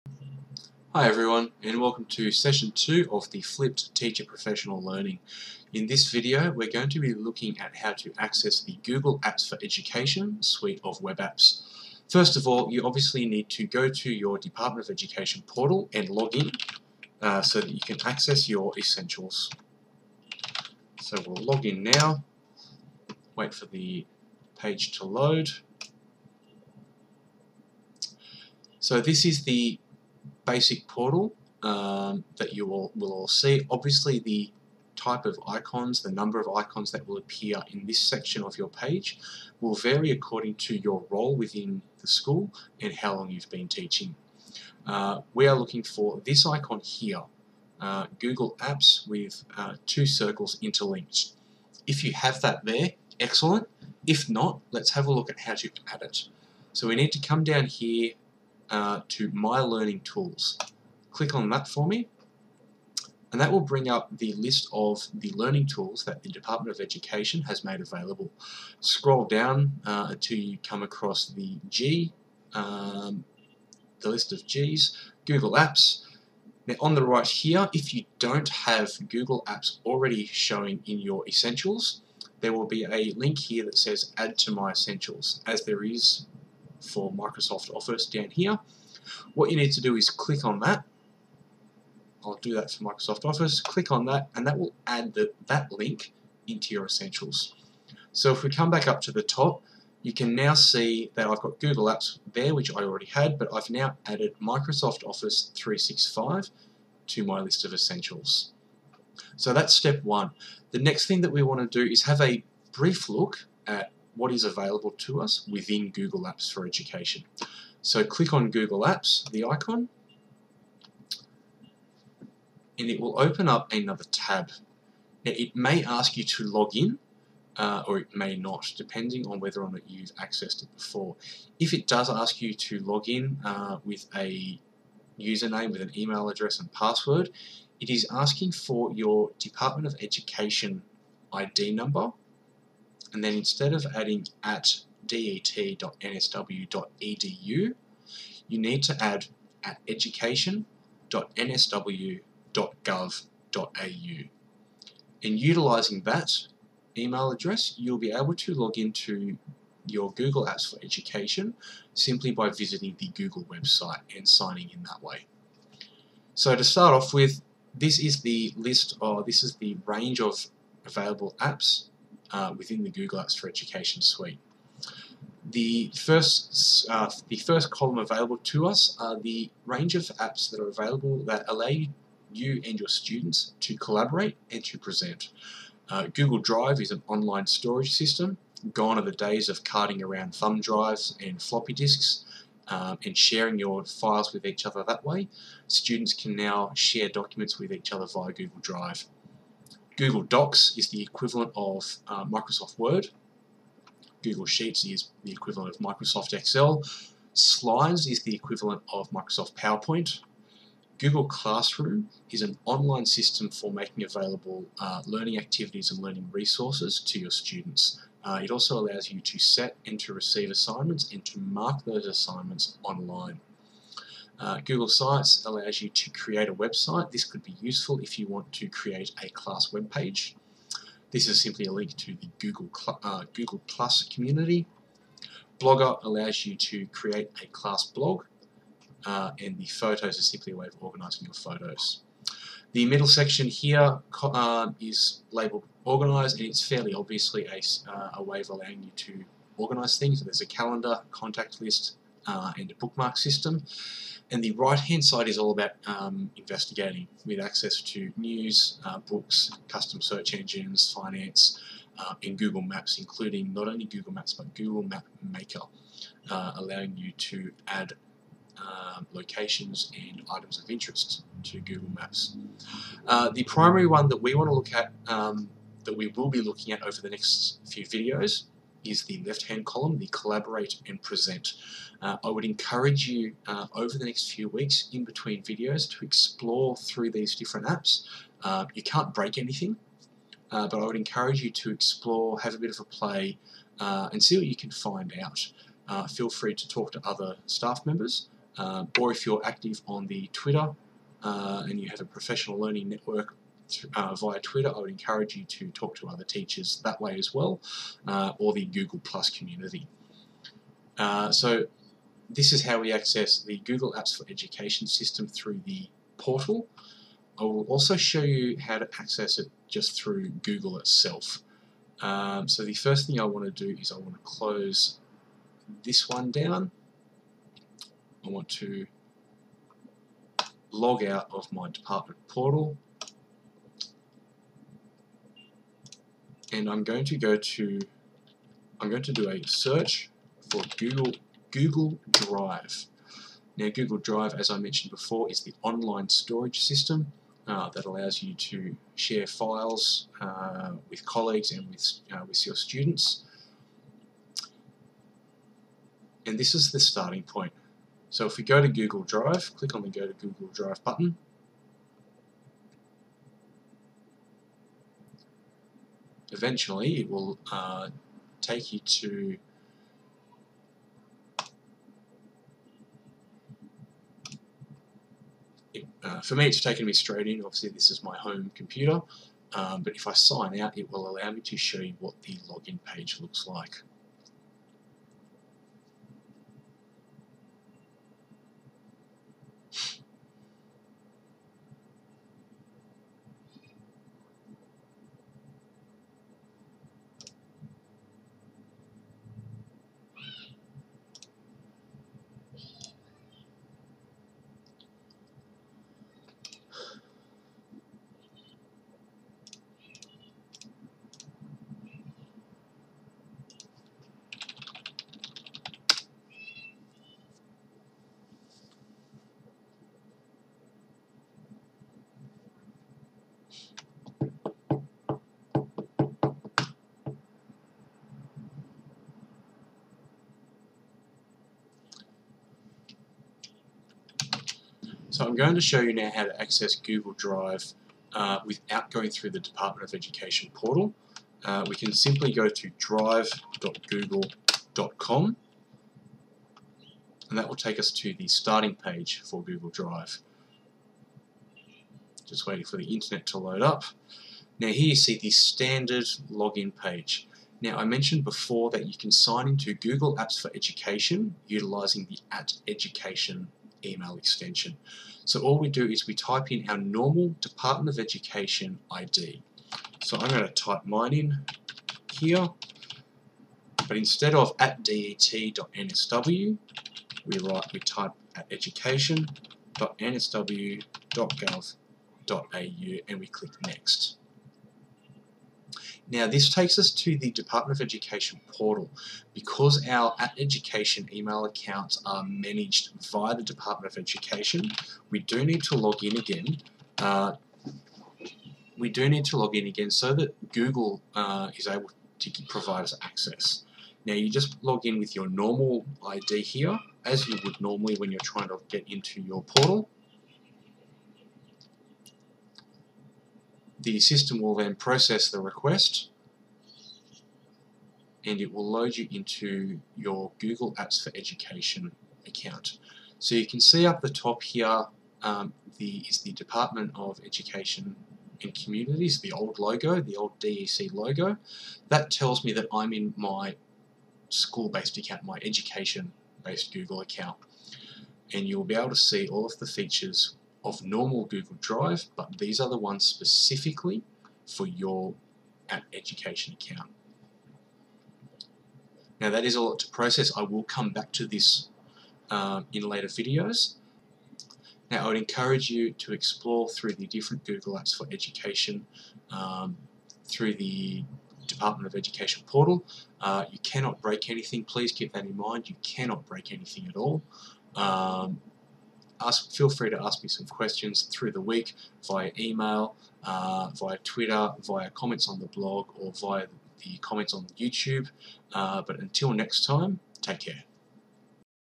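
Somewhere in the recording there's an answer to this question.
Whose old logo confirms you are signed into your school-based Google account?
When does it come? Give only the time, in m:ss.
8:46.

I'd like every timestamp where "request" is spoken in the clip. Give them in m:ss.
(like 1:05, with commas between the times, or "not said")
8:35.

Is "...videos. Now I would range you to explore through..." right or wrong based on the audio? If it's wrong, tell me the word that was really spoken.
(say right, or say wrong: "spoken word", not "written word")
wrong: "encourage", not "range".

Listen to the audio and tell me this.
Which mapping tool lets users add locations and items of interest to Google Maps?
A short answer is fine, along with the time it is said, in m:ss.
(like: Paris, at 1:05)
Google Map Maker, at 4:24.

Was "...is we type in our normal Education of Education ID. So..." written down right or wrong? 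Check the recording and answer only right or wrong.
wrong.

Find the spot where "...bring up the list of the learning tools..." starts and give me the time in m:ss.
1:03.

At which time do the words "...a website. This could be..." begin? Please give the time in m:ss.
3:46.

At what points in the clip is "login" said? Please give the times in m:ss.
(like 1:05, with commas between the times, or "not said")
6:22, 7:36.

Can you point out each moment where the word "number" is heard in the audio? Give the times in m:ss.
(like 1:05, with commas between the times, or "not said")
0:36, 2:21.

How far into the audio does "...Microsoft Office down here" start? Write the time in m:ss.
1:27.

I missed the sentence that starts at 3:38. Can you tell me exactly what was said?
Uh, it also allows you to set and to receive assignments and to mark those assignments online.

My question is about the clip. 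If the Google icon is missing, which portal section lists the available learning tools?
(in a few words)
My Learning Tools.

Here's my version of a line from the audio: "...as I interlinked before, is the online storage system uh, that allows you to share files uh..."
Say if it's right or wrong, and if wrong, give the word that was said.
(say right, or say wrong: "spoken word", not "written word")
wrong: "mentioned", not "interlinked".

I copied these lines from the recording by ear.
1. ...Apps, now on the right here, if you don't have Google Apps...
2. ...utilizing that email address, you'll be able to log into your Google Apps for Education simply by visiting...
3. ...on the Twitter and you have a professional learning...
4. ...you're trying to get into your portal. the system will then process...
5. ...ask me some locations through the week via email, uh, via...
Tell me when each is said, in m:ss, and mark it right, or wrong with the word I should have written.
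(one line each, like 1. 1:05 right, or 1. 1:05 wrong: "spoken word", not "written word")
1. 1:15 right
2. 2:35 right
3. 4:59 right
4. 8:28 right
5. 9:30 wrong: "questions", not "locations".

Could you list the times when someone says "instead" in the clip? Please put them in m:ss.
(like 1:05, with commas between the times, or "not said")
2:23, 7:53.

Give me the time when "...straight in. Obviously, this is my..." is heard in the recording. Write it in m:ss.
6:16.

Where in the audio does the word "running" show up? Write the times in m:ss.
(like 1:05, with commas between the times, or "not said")
not said.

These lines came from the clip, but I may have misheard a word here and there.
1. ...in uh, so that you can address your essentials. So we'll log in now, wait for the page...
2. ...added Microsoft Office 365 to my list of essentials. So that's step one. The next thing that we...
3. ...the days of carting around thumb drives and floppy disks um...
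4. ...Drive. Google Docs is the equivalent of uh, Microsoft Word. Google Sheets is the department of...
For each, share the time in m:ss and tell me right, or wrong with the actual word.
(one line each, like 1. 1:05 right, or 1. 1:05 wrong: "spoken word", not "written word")
1. 0:16 wrong: "access", not "address"
2. 1:44 right
3. 3:09 right
4. 3:18 wrong: "equivalent", not "department".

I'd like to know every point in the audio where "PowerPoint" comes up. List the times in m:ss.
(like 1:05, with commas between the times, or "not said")
3:29.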